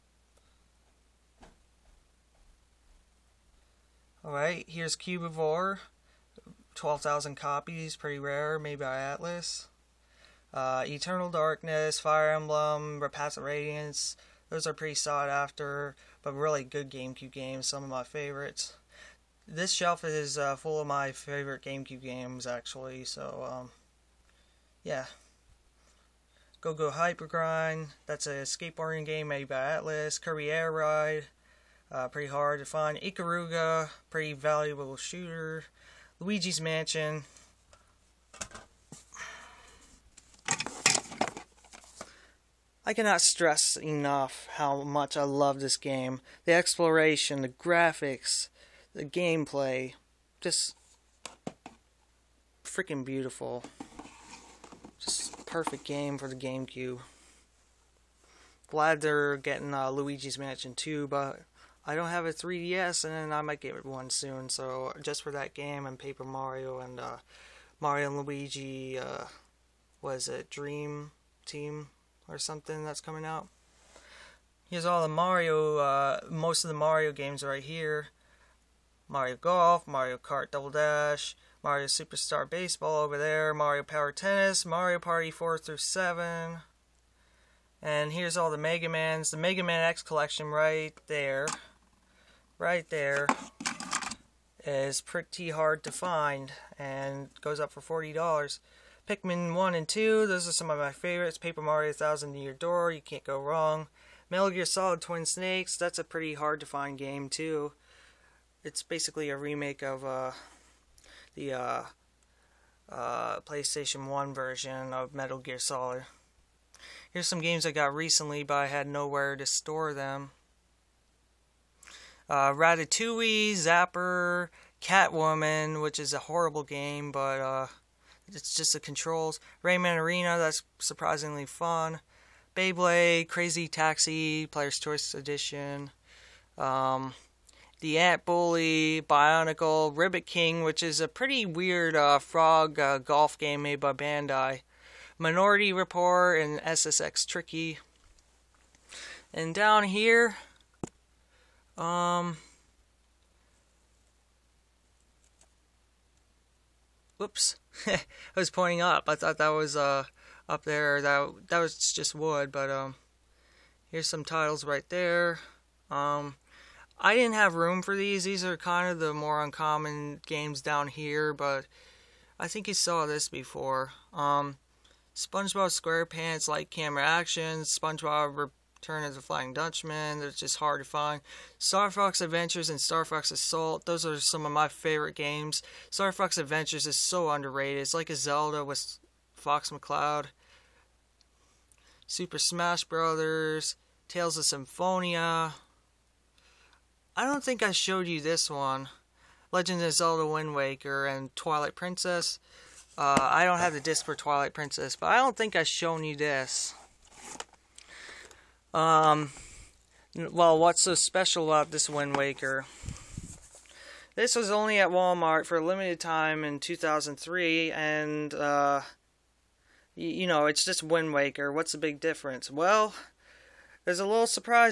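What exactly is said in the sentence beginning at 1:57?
Here's some games I got recently, but I had nowhere to store them.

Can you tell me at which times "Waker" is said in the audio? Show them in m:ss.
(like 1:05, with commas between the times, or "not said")
3:20, 3:32, 3:41.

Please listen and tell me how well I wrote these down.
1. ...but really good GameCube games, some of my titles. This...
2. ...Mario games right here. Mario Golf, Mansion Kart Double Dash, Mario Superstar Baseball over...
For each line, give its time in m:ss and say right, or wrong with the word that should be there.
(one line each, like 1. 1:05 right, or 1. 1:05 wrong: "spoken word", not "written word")
1. 0:16 wrong: "favorites", not "titles"
2. 1:16 wrong: "Mario", not "Mansion".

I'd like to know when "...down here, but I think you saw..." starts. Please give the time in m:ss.
2:50.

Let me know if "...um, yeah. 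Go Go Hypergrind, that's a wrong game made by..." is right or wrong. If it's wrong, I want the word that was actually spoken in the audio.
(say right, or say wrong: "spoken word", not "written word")
wrong: "skateboarding", not "wrong".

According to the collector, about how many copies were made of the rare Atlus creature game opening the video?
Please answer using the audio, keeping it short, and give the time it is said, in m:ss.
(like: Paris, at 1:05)
12,000, at 0:06.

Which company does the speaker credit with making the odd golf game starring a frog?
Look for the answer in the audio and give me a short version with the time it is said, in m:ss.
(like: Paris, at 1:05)
Bandai, at 2:23.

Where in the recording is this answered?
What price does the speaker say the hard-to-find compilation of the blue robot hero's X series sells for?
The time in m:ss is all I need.
1:37.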